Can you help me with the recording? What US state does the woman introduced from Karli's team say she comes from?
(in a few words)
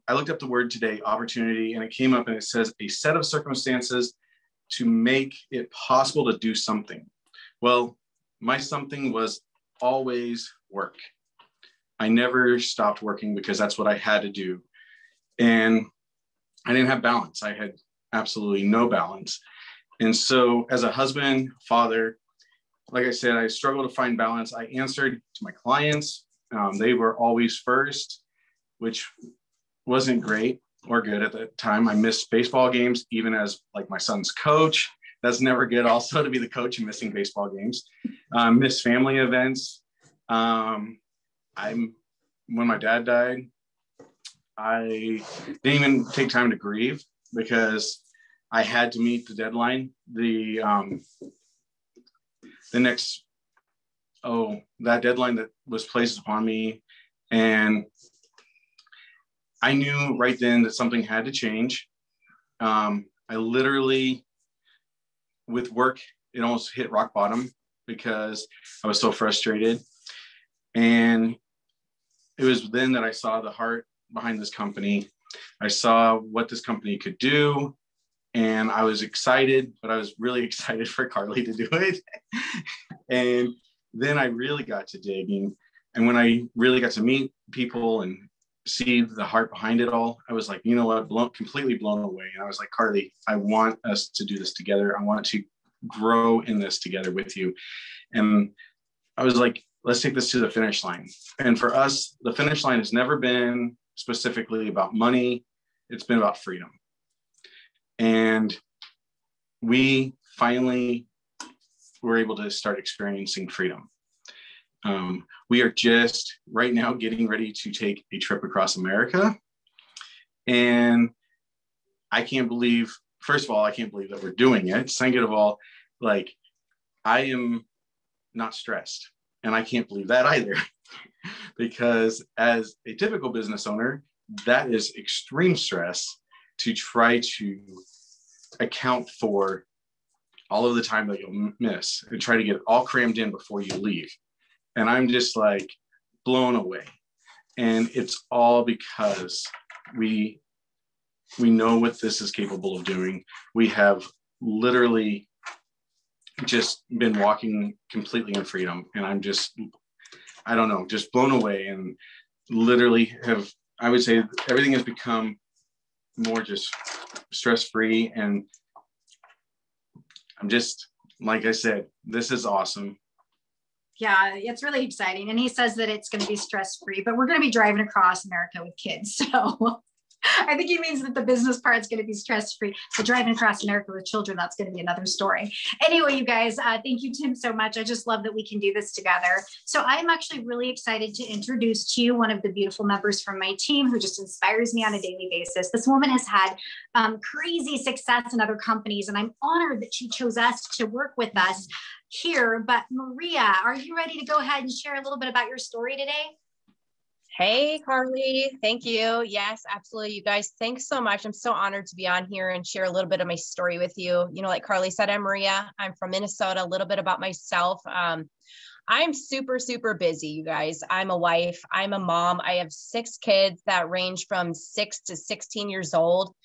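Minnesota.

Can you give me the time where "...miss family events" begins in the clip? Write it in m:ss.
0:38.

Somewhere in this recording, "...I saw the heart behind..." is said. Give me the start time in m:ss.
1:13.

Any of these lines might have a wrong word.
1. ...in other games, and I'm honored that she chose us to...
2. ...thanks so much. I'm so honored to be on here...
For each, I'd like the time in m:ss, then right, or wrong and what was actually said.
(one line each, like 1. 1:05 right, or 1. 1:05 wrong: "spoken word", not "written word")
1. 3:18 wrong: "companies", not "games"
2. 3:30 right.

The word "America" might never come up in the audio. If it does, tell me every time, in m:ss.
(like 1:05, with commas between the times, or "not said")
1:58, 2:58, 3:03.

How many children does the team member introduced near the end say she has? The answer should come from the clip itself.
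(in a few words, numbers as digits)
6.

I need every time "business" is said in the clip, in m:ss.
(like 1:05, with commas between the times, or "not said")
2:13, 3:01.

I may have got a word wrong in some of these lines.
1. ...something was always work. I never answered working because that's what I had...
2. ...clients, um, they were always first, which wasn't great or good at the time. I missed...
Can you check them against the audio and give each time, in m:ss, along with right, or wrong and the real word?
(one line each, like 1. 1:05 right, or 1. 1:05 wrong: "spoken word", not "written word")
1. 0:08 wrong: "stopped", not "answered"
2. 0:25 right.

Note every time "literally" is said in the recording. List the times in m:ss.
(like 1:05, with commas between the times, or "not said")
1:03, 2:34, 2:42.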